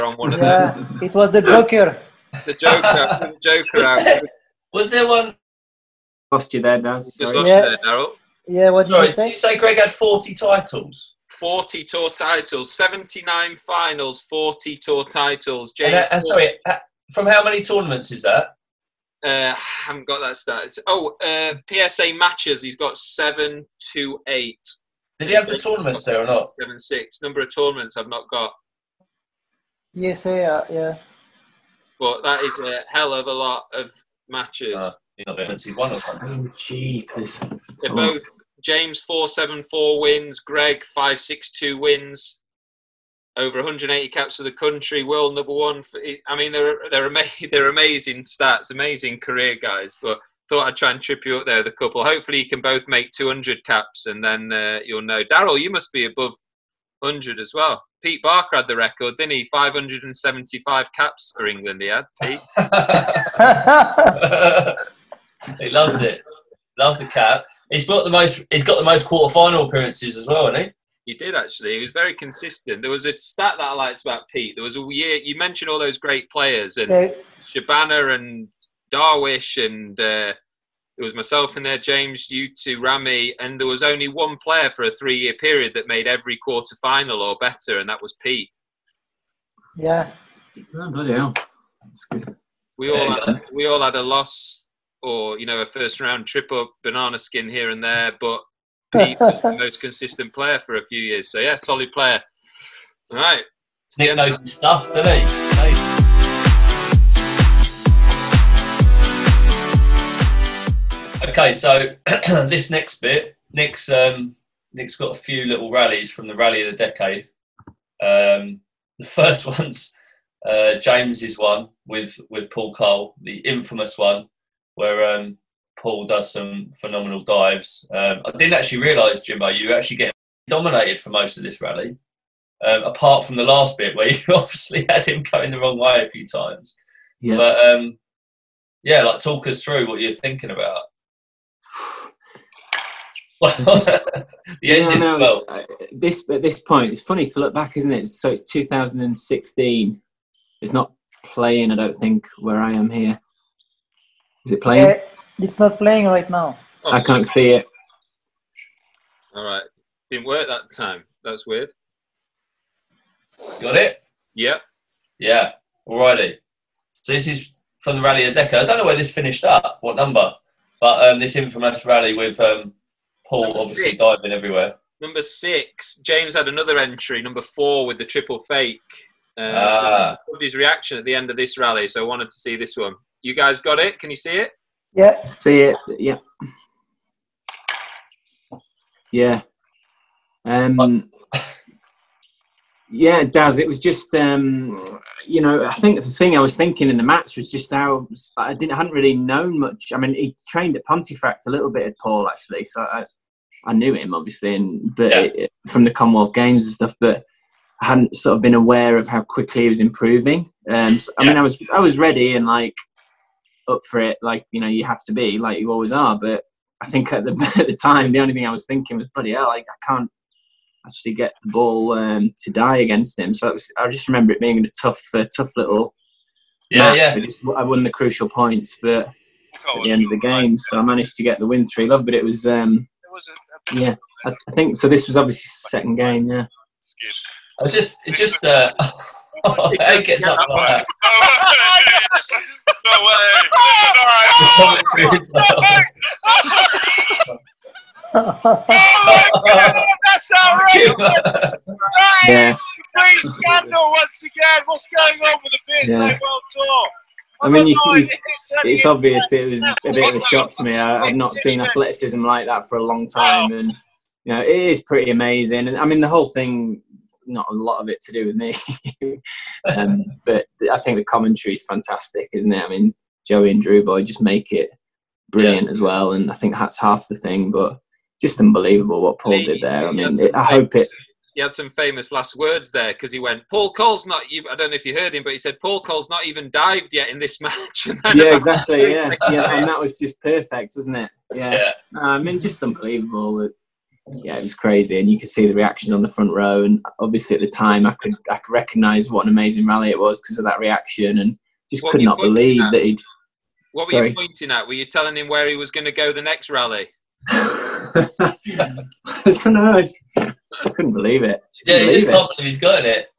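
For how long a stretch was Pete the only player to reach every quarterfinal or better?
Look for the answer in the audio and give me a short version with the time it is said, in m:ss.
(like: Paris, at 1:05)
three-year period, at 1:24.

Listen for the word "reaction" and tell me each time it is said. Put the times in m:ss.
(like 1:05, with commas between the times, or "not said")
3:00, 4:55, 5:00.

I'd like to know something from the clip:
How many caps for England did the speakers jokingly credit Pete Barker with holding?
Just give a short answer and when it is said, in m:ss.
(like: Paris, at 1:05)
575, at 0:59.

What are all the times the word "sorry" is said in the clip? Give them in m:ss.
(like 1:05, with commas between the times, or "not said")
0:08, 0:16, 5:03.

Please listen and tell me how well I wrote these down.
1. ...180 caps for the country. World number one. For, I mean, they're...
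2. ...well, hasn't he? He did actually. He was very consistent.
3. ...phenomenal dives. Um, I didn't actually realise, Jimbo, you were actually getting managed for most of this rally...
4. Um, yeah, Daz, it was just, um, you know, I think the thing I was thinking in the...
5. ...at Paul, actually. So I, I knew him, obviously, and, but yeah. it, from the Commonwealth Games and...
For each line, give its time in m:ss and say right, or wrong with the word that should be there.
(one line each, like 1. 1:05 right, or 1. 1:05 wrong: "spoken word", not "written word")
1. 0:43 right
2. 1:10 right
3. 2:06 wrong: "dominated", not "managed"
4. 3:10 right
5. 3:21 right.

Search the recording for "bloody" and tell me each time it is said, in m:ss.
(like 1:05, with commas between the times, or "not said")
1:30, 3:39.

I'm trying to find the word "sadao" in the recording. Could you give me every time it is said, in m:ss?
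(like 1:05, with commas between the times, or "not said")
not said.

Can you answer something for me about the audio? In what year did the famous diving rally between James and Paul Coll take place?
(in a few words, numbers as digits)
2016.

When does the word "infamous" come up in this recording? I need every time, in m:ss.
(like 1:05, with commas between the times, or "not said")
2:03, 2:51.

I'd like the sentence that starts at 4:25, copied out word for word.
And I mean, the whole thing not a lot of it to do with me.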